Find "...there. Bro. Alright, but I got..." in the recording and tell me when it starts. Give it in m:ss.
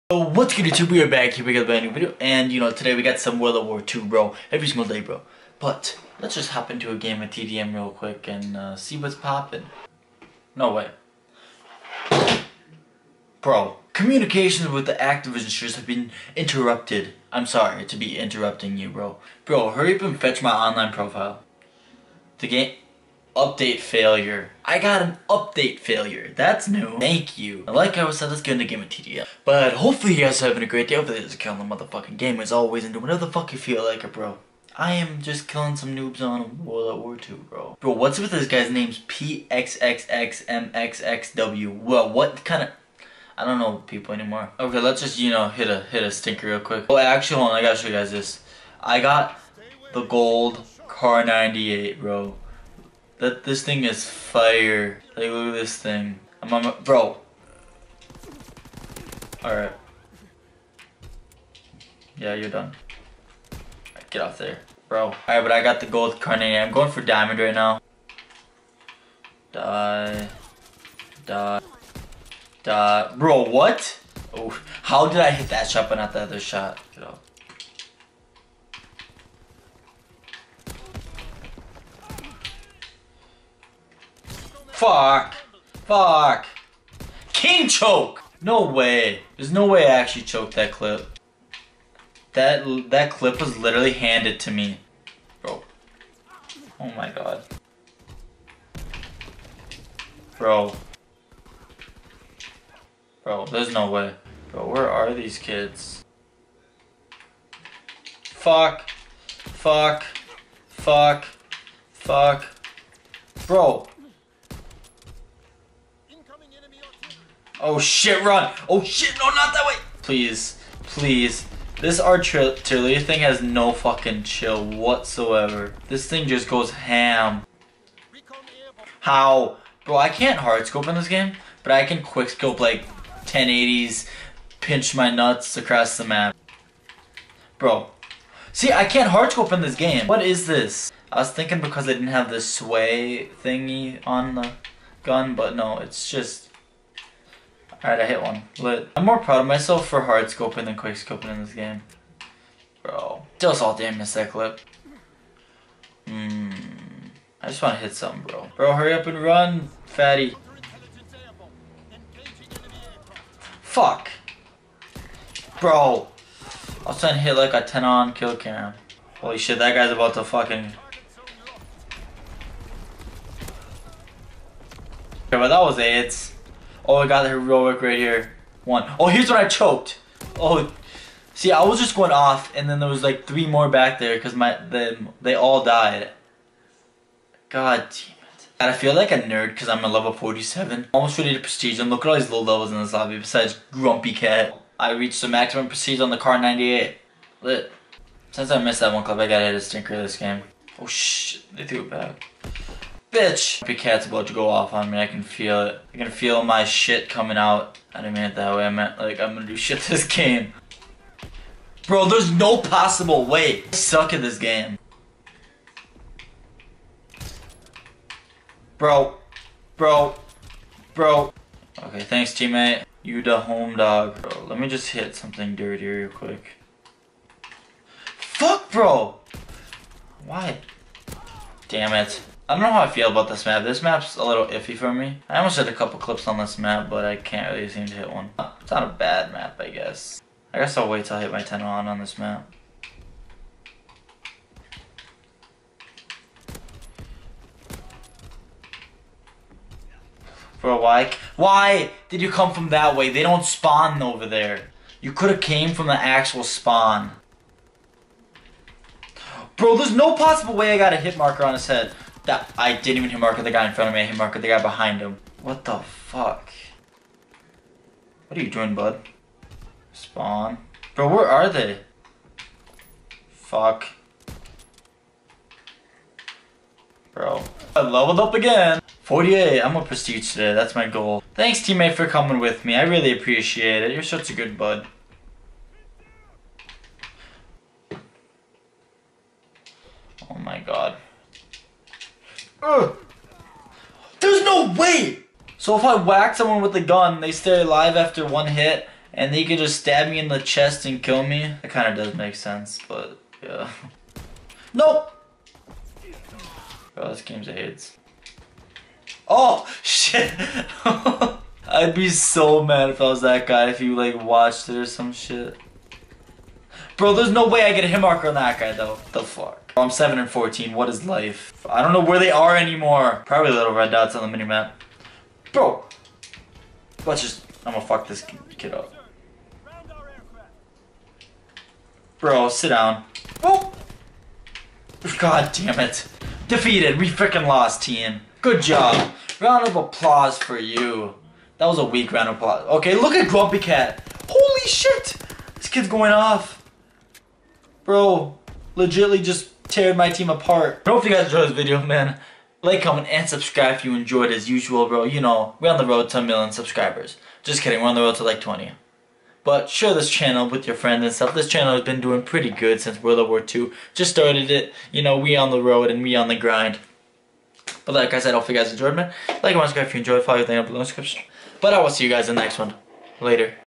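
1:04.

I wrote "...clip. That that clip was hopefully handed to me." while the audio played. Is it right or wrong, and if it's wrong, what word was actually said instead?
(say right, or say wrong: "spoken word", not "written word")
wrong: "literally", not "hopefully".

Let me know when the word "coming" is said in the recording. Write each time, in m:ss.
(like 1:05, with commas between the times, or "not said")
3:27, 4:42.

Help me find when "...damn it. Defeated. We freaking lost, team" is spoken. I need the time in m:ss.
5:35.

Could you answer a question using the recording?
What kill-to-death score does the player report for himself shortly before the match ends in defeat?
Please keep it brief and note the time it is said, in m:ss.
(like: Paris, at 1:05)
7 and 14, at 5:19.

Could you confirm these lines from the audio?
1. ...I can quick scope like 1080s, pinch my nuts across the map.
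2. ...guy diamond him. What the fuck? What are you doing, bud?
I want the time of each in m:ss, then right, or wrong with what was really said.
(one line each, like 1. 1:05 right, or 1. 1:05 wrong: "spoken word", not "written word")
1. 2:11 right
2. 4:24 wrong: "behind", not "diamond".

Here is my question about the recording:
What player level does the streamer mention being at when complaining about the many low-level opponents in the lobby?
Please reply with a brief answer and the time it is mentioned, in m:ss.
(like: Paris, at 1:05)
47, at 3:10.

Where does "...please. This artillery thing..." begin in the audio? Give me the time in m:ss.
2:00.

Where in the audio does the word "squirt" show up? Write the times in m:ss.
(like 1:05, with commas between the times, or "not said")
not said.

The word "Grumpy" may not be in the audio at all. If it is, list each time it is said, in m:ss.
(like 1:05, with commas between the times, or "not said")
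3:13, 5:43.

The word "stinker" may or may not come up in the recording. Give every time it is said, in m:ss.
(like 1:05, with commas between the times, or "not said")
0:46, 3:19.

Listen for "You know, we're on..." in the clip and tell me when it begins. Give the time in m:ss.
5:55.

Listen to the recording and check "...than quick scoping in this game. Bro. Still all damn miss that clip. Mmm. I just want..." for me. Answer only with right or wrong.
right.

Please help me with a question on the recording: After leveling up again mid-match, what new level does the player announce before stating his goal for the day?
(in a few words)
48.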